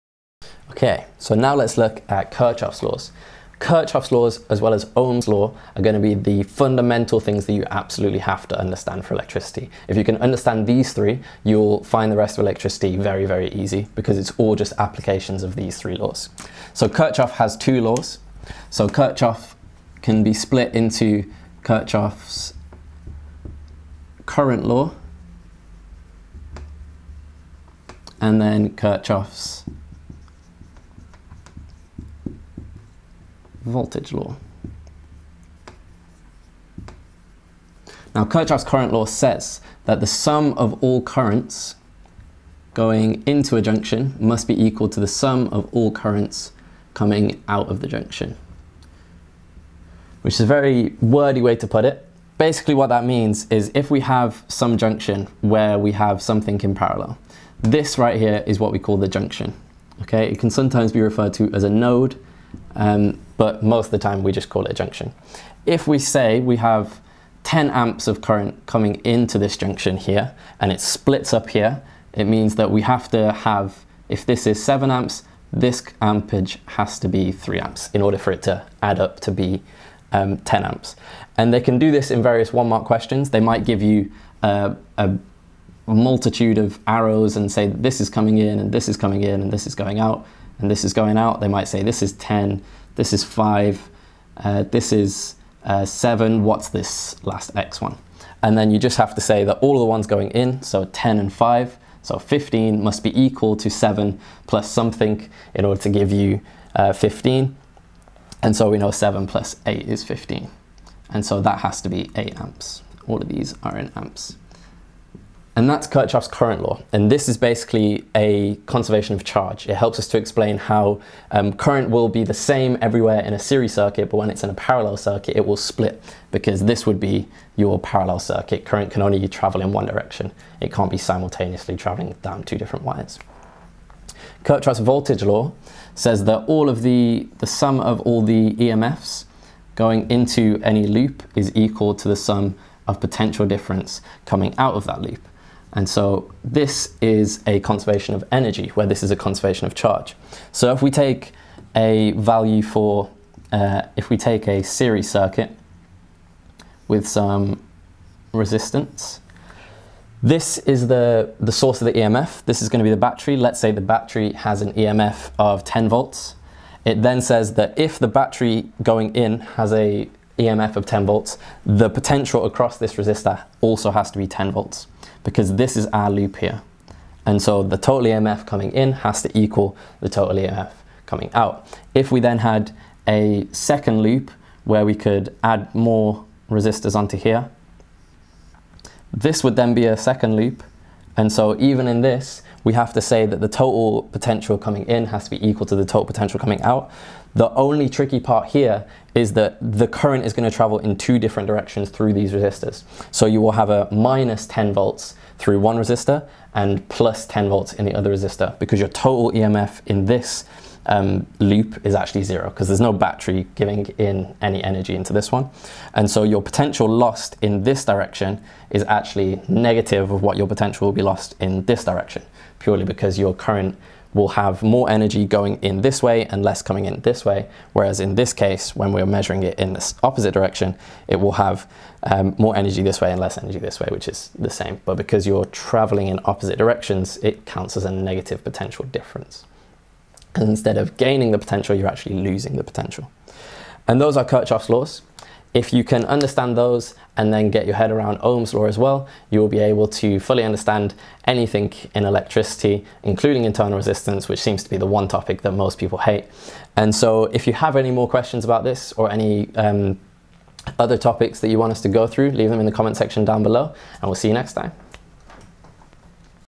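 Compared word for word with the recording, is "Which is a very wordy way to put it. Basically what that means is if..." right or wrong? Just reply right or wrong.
right.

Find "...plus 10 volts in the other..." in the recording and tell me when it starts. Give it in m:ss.
3:26.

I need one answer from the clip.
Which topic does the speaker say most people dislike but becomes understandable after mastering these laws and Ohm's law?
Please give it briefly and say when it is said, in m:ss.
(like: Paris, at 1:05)
internal resistance, at 4:13.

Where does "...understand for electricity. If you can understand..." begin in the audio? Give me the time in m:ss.
0:08.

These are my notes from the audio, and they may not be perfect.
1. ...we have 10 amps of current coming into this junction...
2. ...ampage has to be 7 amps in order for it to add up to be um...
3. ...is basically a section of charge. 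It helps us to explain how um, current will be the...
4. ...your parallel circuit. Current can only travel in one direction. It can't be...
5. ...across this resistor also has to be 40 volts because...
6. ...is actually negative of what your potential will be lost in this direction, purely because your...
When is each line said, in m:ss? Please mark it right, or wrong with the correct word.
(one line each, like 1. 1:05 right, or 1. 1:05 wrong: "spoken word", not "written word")
1. 1:06 right
2. 1:16 wrong: "3", not "7"
3. 1:57 wrong: "conservation", not "section"
4. 2:07 right
5. 2:52 wrong: "10", not "40"
6. 3:38 right.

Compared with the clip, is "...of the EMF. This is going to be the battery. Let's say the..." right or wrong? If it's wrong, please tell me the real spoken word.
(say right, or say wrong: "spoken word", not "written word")
right.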